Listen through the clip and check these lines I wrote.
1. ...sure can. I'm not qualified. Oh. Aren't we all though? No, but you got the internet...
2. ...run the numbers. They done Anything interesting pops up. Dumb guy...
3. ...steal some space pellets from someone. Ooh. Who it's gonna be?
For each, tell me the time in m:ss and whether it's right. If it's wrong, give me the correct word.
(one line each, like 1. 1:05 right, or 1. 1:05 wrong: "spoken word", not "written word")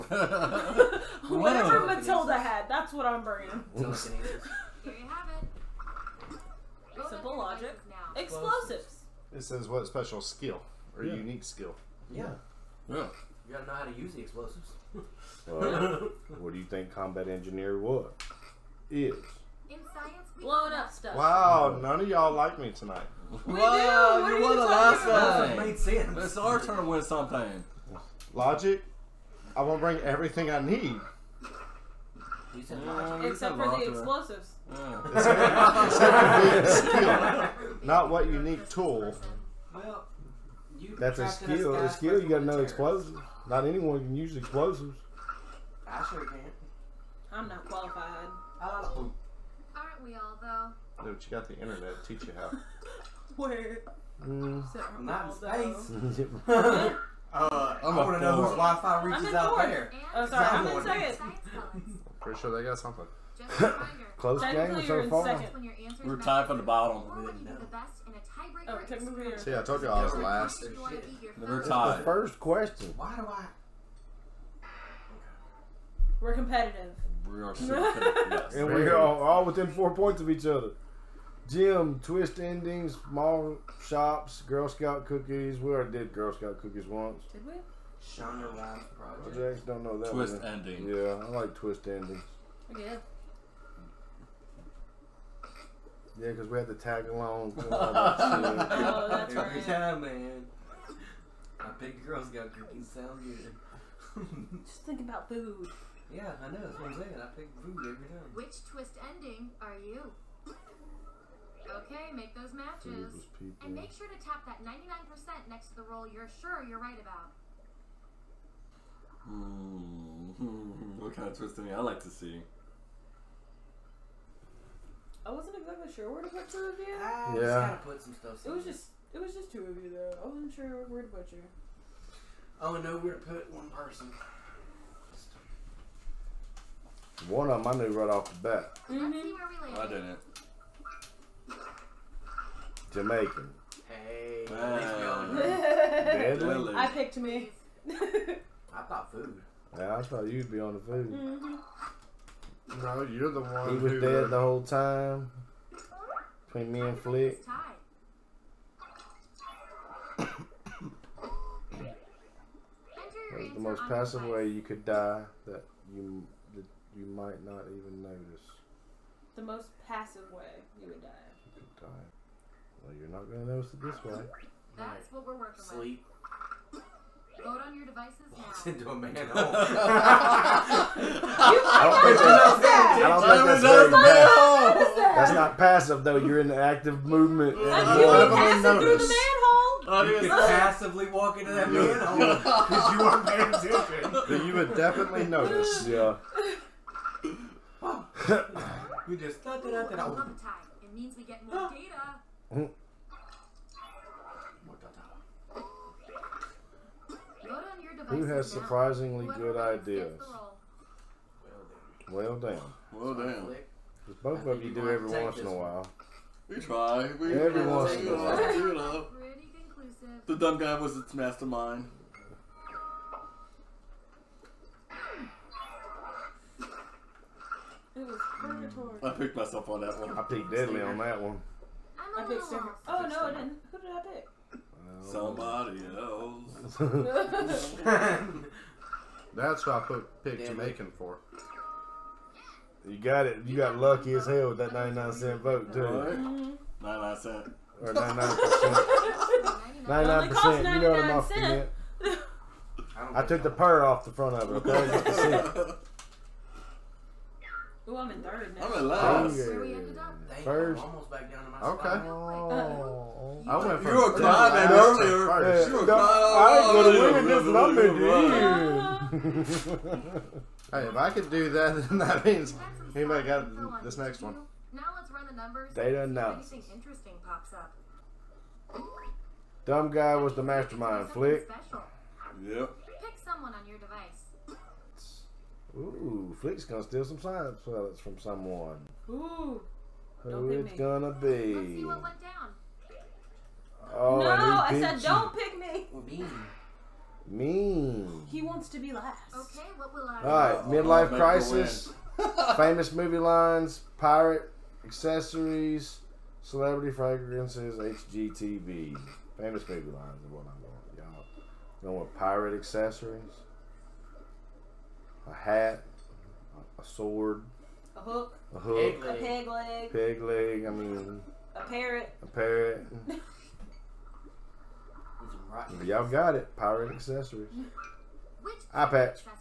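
1. 0:46 right
2. 4:35 right
3. 4:46 wrong: "science", not "space".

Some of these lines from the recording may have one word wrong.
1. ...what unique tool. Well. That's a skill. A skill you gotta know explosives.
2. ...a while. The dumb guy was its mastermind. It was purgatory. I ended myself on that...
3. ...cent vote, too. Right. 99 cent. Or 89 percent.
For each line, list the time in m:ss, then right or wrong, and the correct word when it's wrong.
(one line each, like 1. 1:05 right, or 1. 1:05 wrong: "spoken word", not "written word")
1. 0:38 right
2. 3:38 wrong: "picked", not "ended"
3. 4:05 wrong: "99", not "89".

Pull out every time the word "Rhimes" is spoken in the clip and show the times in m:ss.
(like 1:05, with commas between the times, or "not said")
1:28.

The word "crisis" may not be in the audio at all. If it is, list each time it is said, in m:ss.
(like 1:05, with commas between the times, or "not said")
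5:01.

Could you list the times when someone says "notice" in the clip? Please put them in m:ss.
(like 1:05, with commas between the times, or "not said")
2:48, 2:53, 3:15.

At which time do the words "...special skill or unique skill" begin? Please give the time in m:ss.
0:09.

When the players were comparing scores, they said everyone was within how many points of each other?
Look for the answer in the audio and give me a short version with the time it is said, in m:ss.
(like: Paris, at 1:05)
4, at 1:19.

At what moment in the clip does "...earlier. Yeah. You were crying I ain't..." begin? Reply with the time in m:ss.
4:24.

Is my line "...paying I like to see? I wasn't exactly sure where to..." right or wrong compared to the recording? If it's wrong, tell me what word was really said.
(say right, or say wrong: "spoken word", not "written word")
wrong: "ending", not "paying".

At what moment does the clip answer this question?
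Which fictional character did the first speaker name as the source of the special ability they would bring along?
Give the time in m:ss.
0:01.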